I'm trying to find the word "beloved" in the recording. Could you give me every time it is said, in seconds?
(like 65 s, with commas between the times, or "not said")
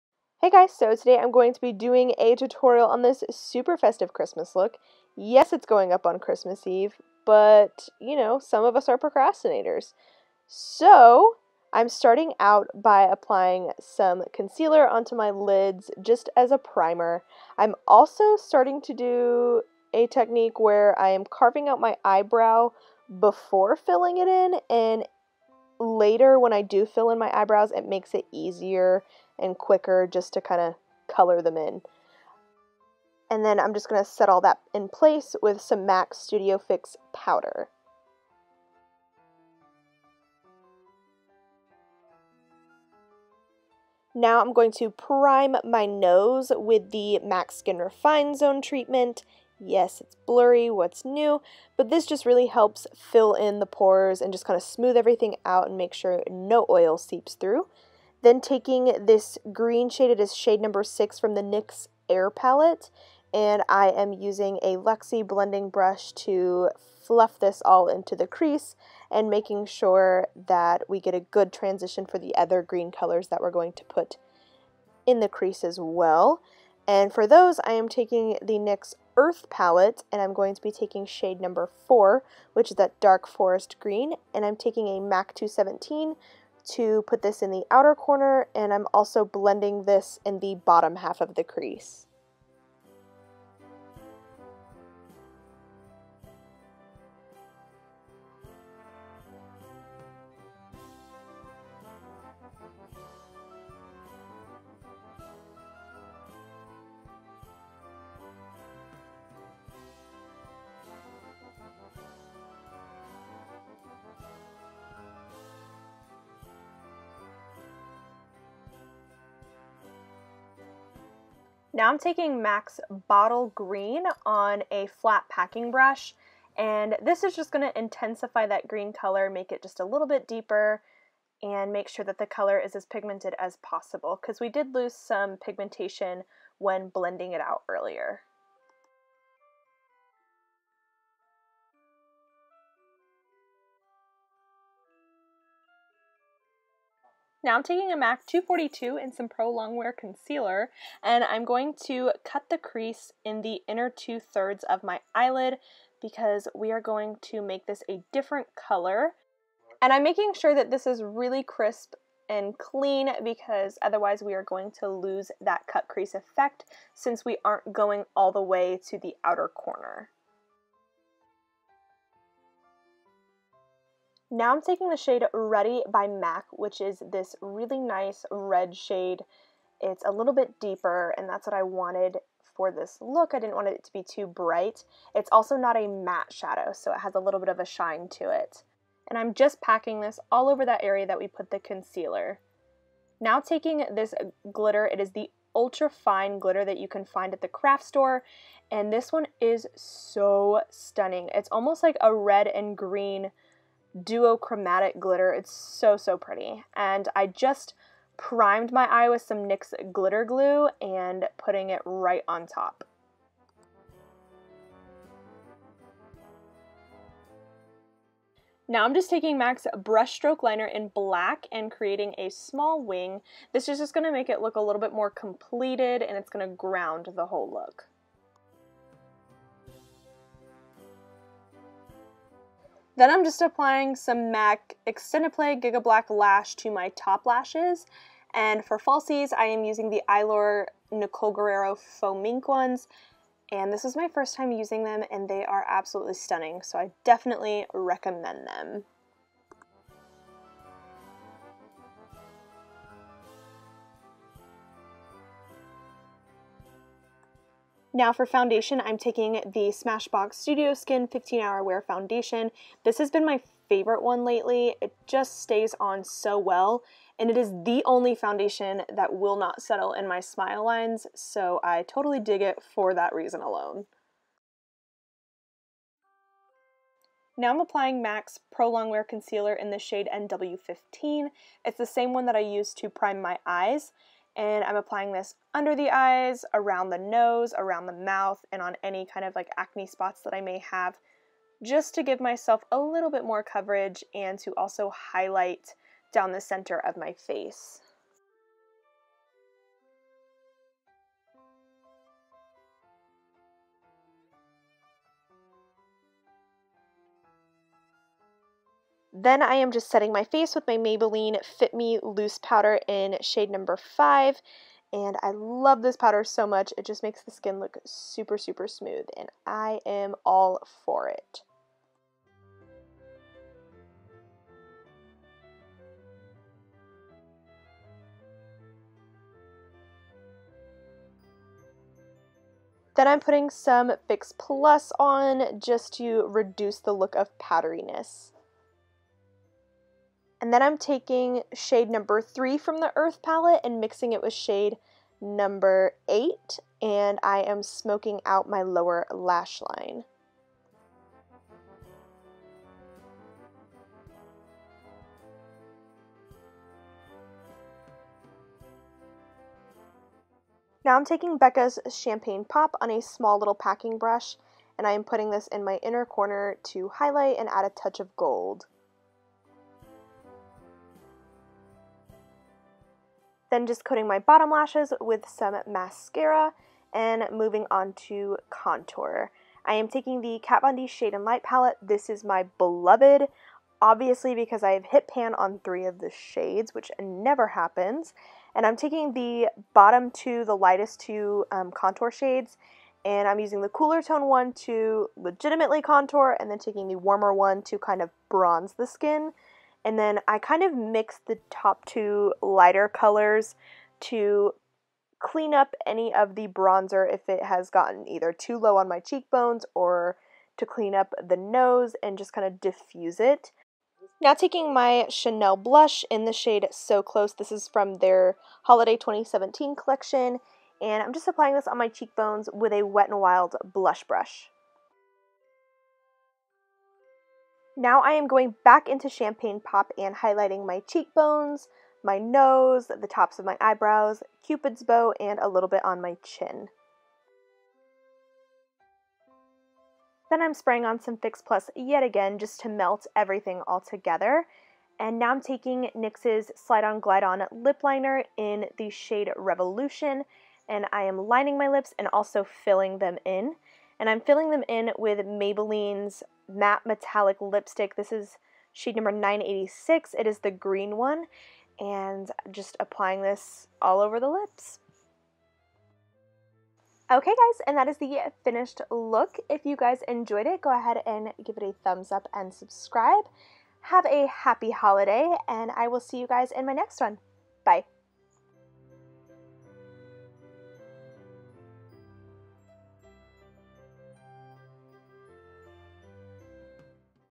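382 s.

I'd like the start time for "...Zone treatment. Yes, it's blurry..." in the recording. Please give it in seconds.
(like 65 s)
48 s.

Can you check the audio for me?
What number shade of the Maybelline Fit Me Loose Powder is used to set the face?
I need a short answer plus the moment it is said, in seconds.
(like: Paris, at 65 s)
5, at 313 s.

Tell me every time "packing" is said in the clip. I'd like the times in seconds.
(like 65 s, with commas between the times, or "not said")
125 s, 189 s, 363 s.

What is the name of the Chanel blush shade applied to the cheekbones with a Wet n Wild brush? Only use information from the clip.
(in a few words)
So Close.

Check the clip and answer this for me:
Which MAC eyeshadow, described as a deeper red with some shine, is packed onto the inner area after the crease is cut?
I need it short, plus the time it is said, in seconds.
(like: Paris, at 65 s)
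Ready, at 174 s.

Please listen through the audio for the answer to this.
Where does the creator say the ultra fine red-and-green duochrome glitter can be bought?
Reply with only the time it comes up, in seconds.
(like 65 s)
197 s.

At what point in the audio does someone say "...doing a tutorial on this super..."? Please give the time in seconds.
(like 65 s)
1 s.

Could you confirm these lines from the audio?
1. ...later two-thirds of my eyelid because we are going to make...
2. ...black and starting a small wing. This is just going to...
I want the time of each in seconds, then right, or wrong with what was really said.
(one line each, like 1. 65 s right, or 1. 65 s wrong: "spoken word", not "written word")
1. 153 s wrong: "inner", not "later"
2. 220 s wrong: "creating", not "starting".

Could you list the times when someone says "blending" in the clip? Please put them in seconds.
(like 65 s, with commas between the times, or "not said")
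65 s, 89 s, 136 s.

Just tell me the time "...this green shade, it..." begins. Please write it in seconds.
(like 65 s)
59 s.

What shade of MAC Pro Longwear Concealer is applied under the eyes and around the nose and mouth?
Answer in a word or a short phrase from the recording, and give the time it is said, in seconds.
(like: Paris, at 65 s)
NW15, at 280 s.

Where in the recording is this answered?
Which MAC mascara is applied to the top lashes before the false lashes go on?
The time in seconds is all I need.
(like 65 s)
234 s.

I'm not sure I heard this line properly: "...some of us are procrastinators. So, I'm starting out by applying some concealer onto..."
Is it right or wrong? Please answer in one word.
right.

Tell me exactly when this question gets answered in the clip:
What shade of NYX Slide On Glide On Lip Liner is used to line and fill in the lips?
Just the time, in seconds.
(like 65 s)
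449 s.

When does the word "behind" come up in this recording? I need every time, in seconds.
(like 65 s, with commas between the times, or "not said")
not said.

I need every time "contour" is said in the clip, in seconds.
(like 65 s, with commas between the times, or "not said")
378 s, 391 s, 395 s.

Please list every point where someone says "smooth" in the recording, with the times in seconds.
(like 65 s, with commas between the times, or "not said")
54 s, 318 s.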